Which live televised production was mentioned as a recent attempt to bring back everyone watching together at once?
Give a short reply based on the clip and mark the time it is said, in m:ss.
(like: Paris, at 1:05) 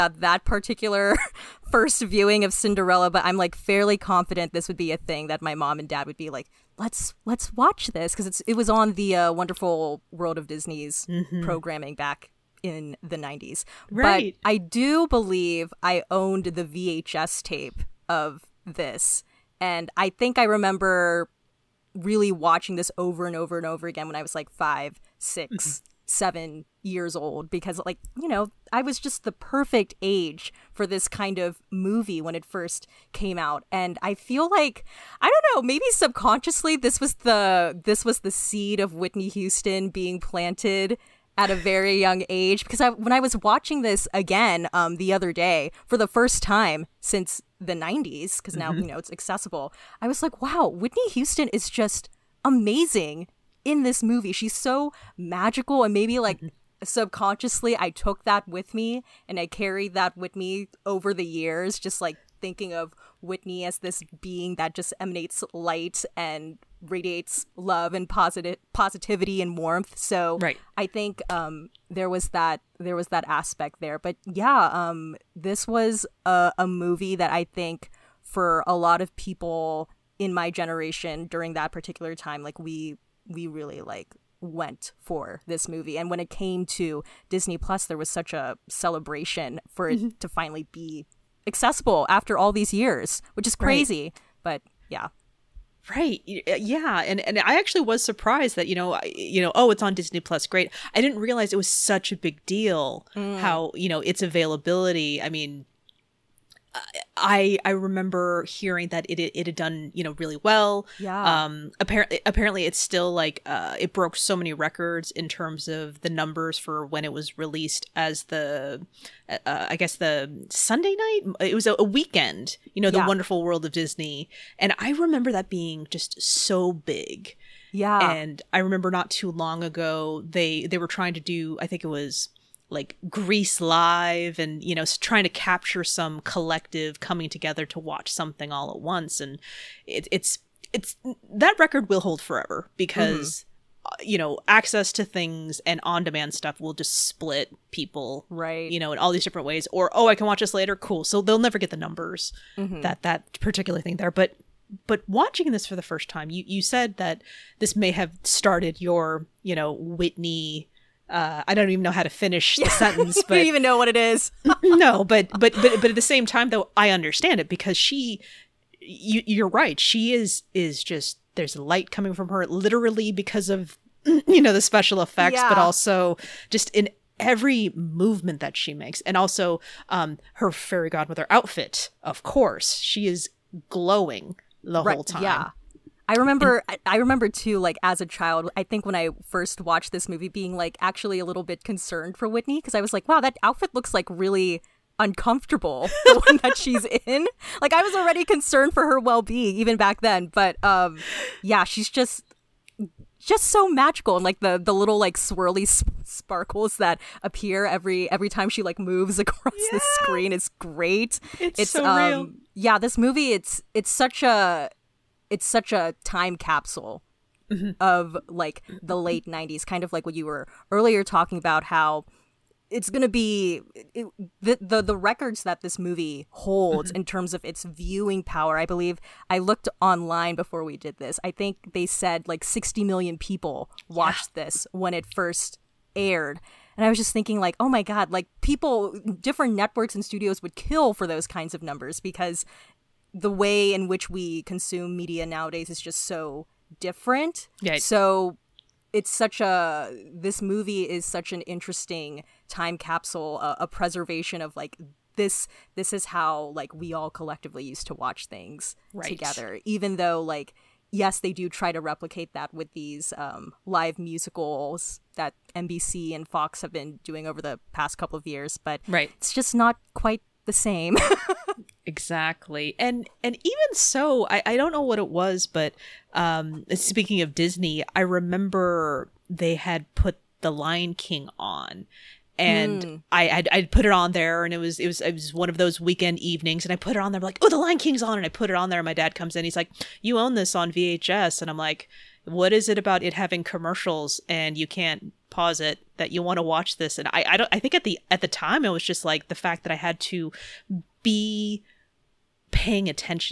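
Grease Live, at 2:13.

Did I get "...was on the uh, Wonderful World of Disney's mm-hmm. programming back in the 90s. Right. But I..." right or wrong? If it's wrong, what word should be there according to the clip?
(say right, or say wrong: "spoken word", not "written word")
right.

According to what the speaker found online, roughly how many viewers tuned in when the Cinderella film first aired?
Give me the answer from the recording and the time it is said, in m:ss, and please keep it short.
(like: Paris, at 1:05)
60 million, at 3:52.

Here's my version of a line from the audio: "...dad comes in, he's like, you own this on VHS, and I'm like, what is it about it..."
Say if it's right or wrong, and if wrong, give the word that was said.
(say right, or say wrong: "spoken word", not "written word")
right.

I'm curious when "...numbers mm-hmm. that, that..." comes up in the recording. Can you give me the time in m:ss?
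2:31.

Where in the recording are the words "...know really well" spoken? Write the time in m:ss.
1:50.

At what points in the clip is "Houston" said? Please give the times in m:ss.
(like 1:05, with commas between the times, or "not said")
0:39, 0:51.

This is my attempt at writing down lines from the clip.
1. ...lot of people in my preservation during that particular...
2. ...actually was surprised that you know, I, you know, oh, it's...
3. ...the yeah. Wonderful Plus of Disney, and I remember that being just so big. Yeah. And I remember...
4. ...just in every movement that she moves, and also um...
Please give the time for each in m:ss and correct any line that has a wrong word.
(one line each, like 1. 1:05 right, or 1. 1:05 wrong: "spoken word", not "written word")
1. 1:18 wrong: "generation", not "preservation"
2. 1:37 right
3. 2:02 wrong: "World", not "Plus"
4. 2:56 wrong: "makes", not "moves".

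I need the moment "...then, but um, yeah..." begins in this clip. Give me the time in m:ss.
3:19.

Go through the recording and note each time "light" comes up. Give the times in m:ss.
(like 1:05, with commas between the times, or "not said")
1:05, 2:51.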